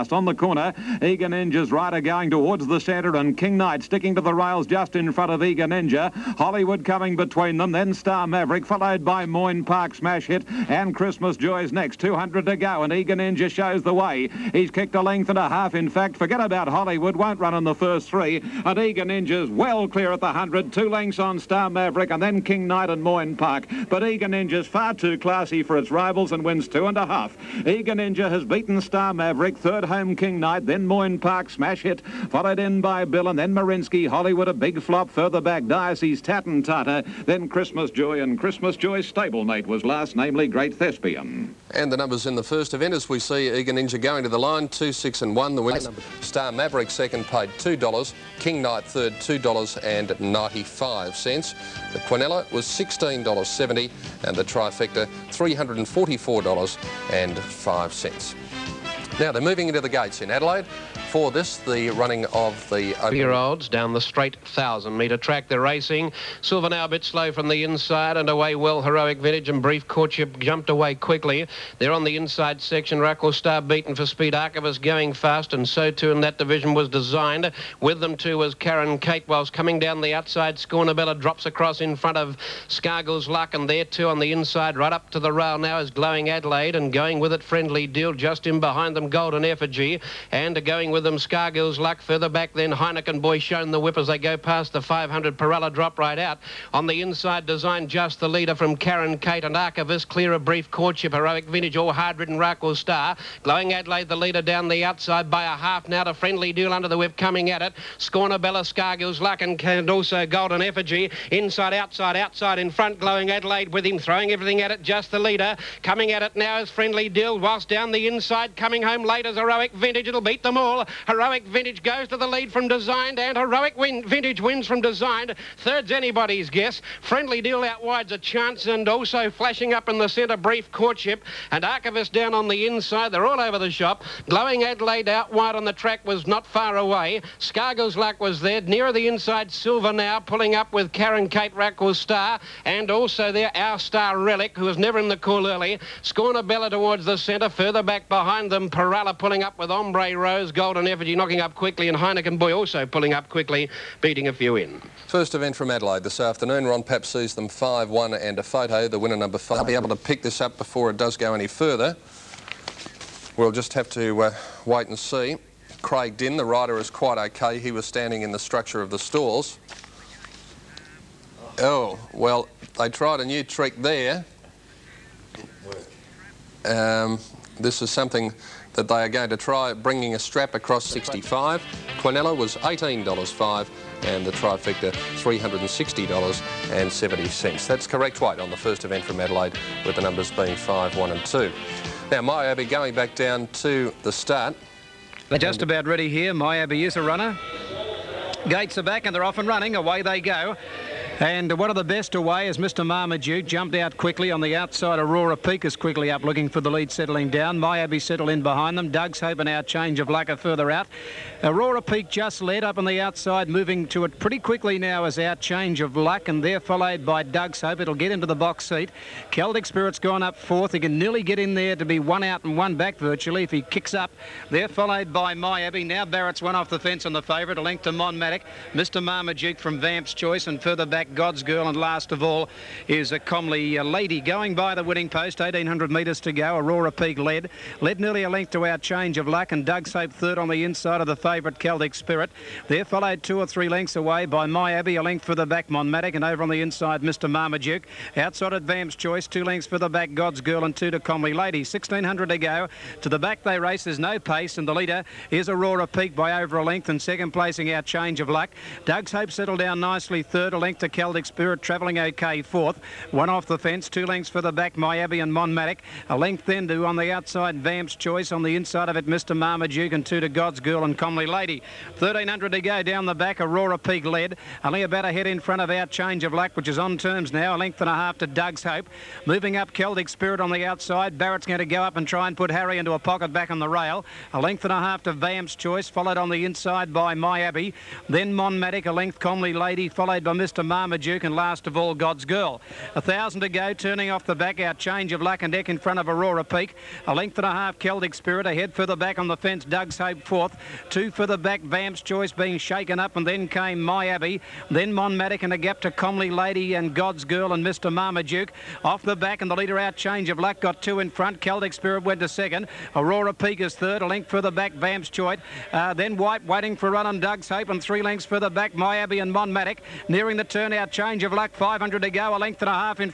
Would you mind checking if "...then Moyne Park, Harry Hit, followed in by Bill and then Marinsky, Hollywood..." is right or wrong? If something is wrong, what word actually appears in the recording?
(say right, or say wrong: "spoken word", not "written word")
wrong: "Smash", not "Harry".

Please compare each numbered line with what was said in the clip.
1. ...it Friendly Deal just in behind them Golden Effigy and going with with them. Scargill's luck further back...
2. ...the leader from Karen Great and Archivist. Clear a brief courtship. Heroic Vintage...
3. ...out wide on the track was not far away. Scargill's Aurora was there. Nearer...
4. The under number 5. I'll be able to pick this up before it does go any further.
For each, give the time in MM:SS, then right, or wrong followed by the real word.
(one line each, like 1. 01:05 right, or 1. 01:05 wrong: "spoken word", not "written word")
1. 01:27 right
2. 01:38 wrong: "Kate", not "Great"
3. 02:15 wrong: "Luck", not "Aurora"
4. 02:38 wrong: "winner", not "under".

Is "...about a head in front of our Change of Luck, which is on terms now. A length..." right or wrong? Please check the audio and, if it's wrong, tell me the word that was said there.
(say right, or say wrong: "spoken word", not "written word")
right.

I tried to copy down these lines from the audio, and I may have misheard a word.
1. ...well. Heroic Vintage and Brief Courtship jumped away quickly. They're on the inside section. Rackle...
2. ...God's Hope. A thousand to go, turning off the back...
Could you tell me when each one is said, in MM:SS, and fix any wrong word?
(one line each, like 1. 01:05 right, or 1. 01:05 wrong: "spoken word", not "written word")
1. 01:08 right
2. 04:51 wrong: "Girl", not "Hope".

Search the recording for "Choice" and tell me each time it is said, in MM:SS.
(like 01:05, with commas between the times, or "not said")
03:50, 04:08, 04:27, 04:45, 05:02, 05:15.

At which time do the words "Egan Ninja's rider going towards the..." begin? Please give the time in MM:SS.
00:01.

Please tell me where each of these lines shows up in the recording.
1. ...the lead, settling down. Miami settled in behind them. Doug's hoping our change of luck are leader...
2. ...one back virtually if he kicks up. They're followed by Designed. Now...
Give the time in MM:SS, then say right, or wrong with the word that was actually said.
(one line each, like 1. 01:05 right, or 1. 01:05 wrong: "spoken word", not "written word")
1. 03:26 wrong: "further", not "leader"
2. 03:42 wrong: "Miami", not "Designed".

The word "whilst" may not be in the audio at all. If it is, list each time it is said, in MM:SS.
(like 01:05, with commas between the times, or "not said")
01:19, 01:57.